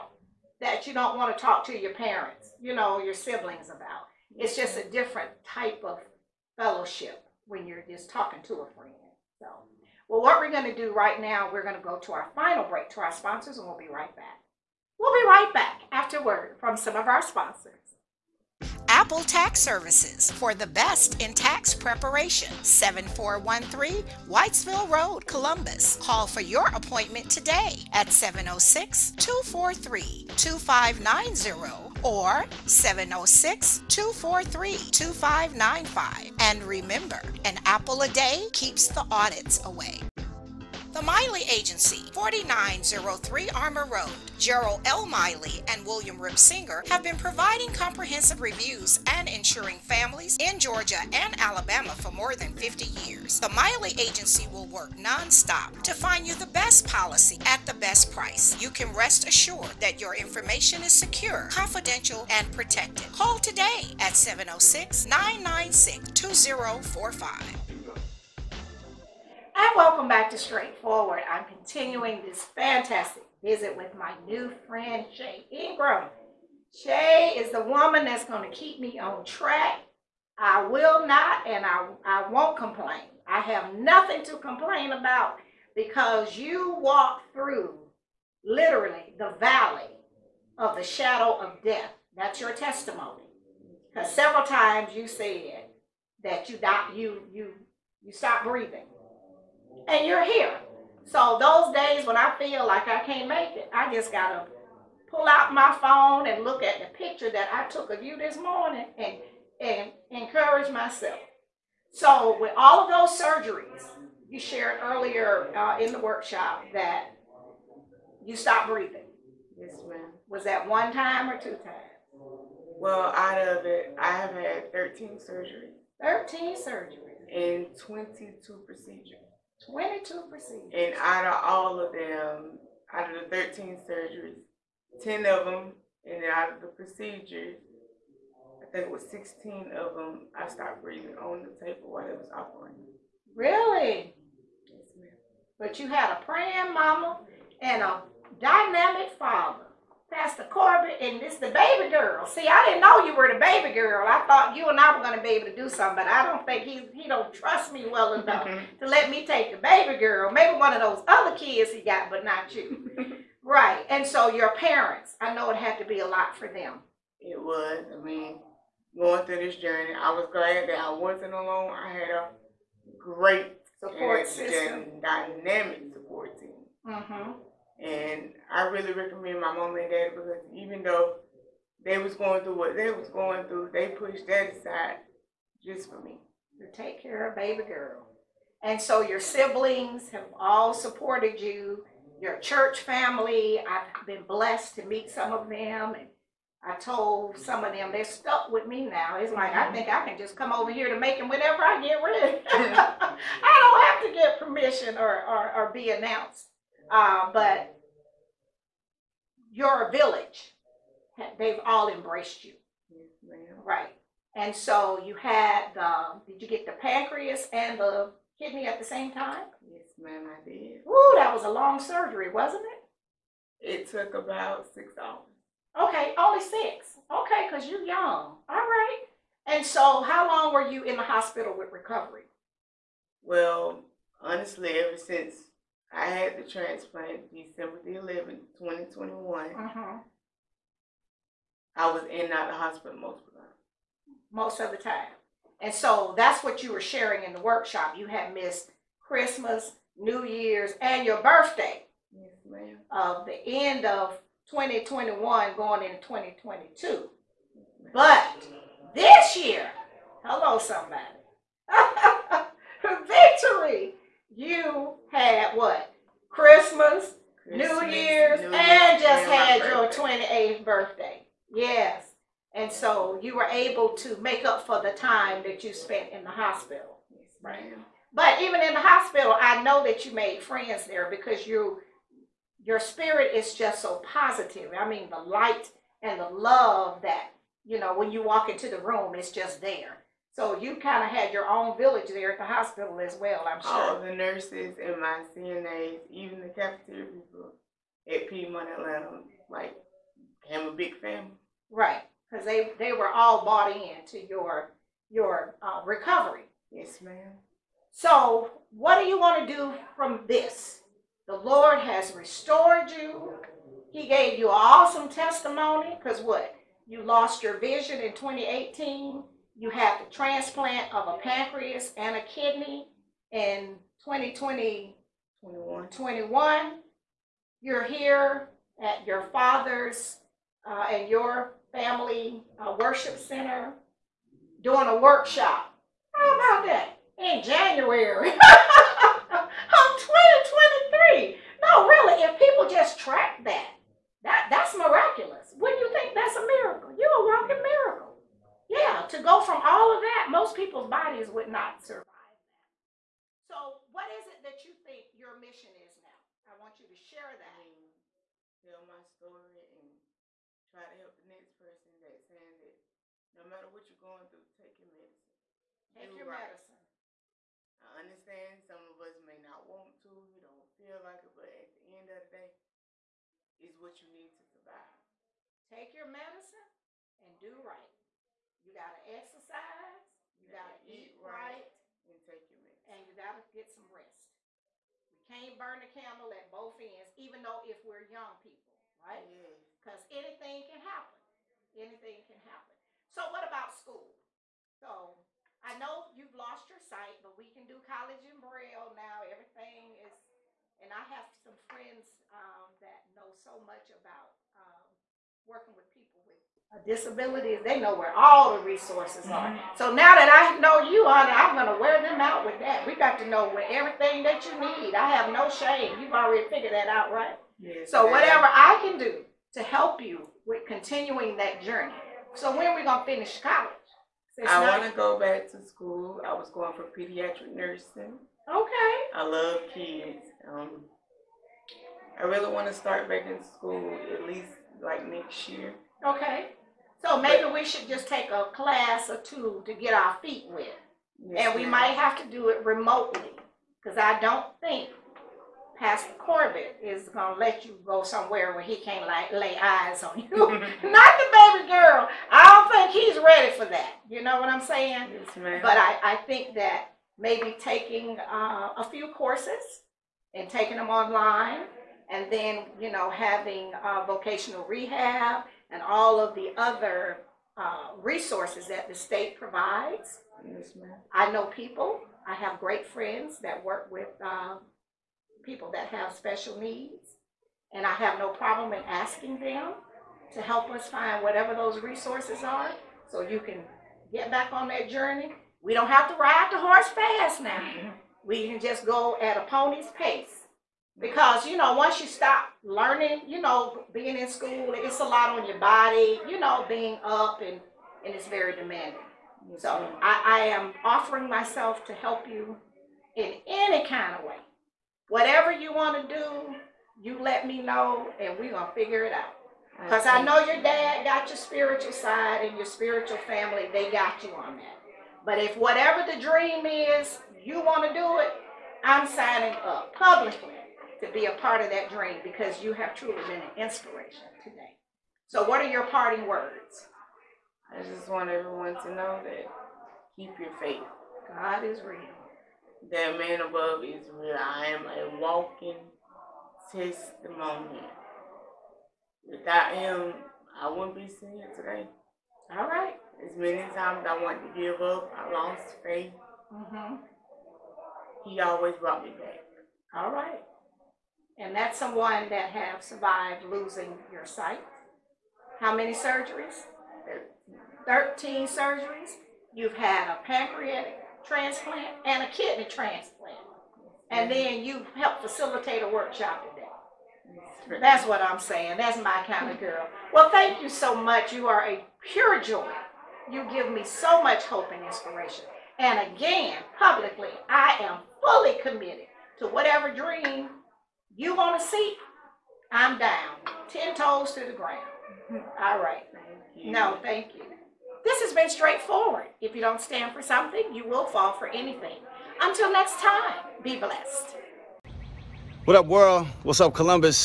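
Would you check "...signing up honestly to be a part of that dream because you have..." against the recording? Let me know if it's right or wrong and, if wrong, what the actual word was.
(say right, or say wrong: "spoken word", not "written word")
wrong: "publicly", not "honestly".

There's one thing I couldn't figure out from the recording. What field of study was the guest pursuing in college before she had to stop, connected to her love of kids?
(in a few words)
pediatric nursing.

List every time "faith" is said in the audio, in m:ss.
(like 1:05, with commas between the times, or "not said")
8:50, 9:05.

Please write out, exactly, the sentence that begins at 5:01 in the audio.
Right, because they, they were all bought in to your, your uh, recovery.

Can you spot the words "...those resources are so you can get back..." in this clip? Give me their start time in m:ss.
8:01.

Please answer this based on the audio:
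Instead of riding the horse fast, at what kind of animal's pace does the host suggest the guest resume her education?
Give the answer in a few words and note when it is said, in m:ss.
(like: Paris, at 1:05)
pony, at 8:09.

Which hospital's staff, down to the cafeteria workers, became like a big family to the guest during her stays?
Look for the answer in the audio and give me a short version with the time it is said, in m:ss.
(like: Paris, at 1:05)
Piedmont Atlanta, at 4:58.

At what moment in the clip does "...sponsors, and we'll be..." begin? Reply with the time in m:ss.
0:13.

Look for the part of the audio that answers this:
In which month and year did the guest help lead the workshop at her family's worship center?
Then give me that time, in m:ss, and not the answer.
5:37.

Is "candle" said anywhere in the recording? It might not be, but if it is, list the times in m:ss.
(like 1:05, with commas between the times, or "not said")
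6:25.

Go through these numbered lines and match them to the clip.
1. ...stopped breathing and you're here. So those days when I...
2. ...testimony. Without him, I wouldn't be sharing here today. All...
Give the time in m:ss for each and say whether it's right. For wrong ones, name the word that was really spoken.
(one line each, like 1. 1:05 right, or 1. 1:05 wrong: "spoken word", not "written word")
1. 1:38 right
2. 8:56 wrong: "sitting", not "sharing".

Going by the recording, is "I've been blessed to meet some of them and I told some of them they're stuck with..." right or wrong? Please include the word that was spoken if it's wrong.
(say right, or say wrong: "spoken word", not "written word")
right.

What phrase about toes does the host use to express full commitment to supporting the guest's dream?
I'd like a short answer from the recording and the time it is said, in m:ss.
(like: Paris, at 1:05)
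Ten toes to the ground, at 9:43.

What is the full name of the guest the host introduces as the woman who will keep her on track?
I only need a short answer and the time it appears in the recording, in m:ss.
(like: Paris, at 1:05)
Shay Ingram, at 1:15.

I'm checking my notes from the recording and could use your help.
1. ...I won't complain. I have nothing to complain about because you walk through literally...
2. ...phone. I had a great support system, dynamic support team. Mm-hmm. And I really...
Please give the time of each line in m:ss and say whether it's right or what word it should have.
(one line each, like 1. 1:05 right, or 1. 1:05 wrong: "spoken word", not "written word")
1. 1:22 right
2. 2:51 wrong: "alone", not "phone".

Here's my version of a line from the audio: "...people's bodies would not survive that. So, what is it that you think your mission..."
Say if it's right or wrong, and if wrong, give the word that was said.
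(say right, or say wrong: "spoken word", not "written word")
right.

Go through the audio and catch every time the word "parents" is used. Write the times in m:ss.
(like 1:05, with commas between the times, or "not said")
0:01, 2:44.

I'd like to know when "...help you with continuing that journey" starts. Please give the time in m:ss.
6:59.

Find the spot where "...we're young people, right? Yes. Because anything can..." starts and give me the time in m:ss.
6:27.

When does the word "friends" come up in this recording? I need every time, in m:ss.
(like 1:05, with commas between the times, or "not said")
0:08, 1:14, 4:40, 6:41, 7:52.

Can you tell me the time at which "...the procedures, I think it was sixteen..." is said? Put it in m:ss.
2:16.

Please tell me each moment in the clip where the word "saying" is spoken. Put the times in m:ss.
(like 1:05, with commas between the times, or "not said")
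6:02, 7:34, 9:28.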